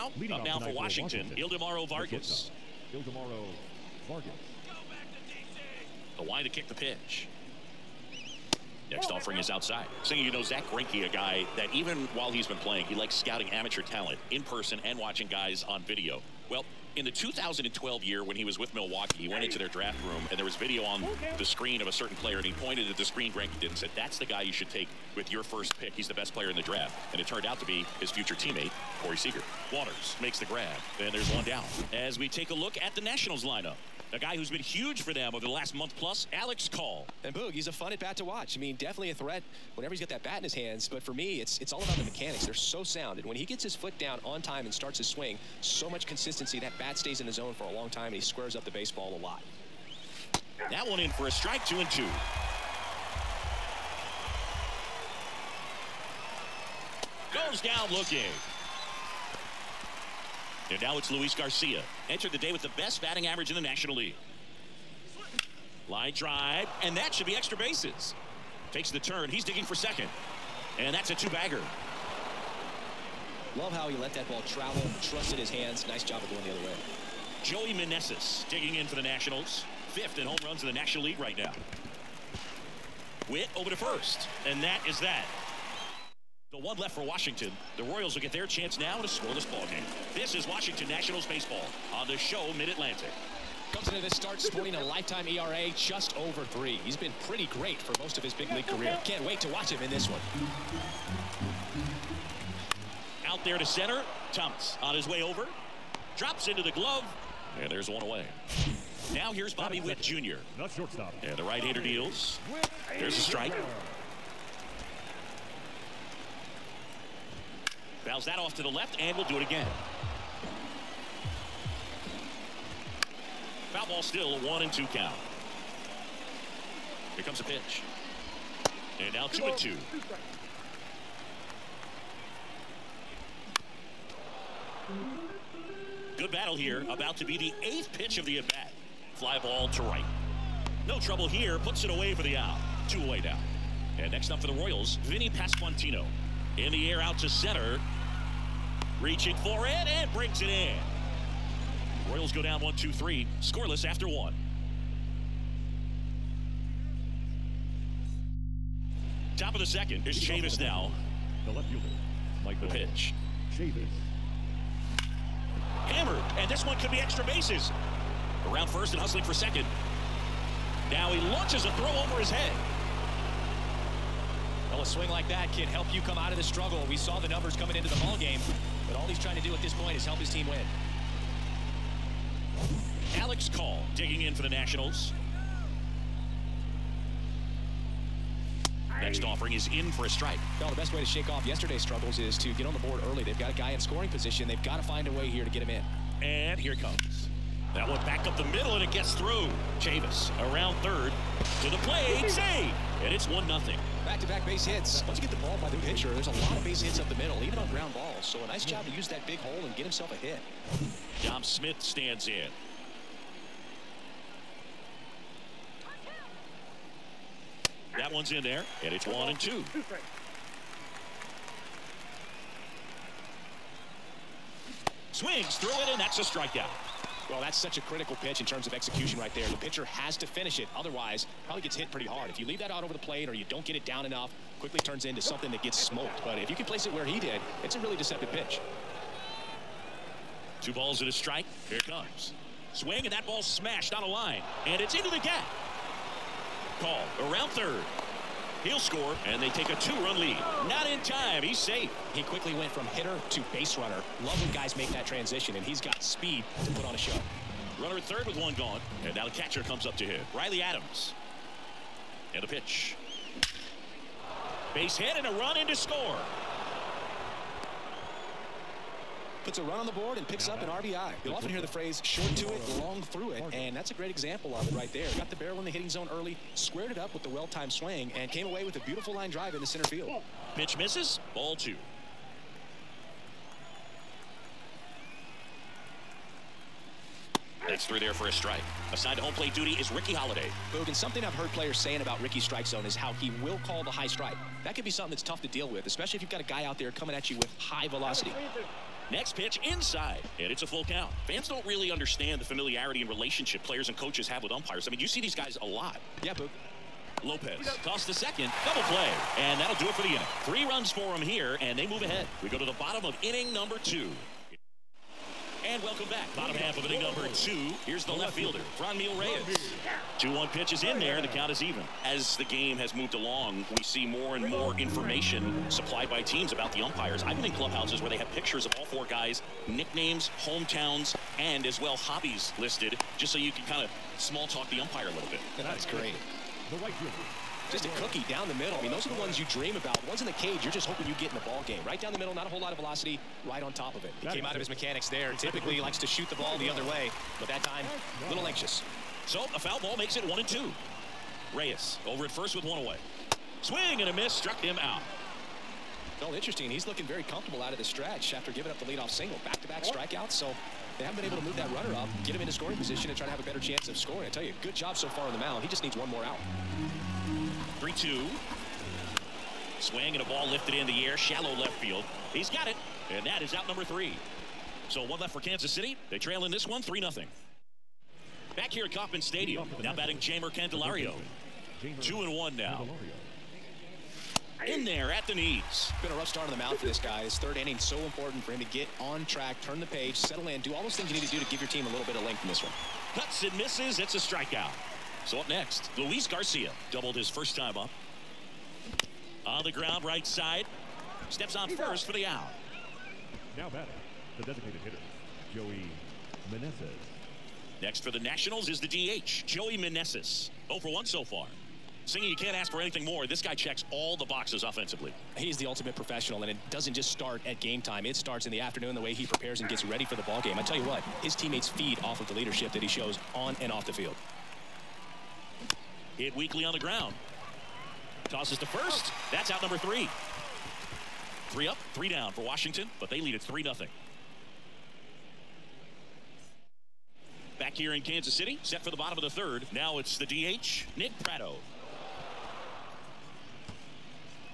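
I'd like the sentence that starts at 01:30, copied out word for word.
This is Washington Nationals baseball on the show Mid-Atlantic.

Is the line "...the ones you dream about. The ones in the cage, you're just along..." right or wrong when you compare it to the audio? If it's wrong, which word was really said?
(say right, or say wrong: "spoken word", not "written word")
wrong: "hoping", not "along".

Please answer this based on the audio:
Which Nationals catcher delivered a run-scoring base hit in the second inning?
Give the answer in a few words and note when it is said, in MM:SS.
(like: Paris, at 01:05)
Riley Adams, at 04:20.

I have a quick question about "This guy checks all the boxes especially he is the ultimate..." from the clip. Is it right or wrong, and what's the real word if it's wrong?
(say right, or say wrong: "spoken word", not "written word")
wrong: "offensively", not "especially".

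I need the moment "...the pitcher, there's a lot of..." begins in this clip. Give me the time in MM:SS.
03:25.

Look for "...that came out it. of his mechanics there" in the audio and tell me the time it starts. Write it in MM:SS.
05:44.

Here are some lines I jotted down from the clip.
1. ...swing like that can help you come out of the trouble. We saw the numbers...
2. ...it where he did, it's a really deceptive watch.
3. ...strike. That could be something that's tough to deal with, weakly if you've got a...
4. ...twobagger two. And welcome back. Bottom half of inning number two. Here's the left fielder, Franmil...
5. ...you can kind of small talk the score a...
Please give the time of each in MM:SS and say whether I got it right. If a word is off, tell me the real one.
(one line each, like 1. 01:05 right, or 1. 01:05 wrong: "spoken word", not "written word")
1. 02:54 wrong: "struggle", not "trouble"
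2. 03:56 wrong: "pitch", not "watch"
3. 04:54 wrong: "especially", not "weakly"
4. 05:13 wrong: "number", not "twobagger"
5. 05:33 wrong: "umpire", not "score".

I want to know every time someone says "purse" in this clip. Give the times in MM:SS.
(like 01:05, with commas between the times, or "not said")
not said.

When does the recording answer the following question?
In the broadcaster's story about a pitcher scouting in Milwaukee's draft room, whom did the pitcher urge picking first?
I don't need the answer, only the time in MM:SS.
00:29.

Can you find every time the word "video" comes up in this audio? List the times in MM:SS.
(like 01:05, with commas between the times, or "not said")
00:15, 00:20.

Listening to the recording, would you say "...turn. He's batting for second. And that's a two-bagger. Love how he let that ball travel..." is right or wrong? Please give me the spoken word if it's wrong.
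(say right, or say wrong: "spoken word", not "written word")
wrong: "digging", not "batting".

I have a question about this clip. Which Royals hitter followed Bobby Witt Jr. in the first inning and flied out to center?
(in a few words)
Vinny Pasquantino.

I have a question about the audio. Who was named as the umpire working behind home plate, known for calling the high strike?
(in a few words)
Ricky Holiday.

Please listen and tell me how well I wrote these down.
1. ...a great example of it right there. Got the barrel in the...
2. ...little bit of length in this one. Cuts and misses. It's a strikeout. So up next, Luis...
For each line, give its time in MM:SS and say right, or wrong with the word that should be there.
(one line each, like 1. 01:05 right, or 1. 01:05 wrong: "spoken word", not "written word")
1. 04:33 right
2. 06:31 right.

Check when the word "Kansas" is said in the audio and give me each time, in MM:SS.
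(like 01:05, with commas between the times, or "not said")
06:15, 07:17.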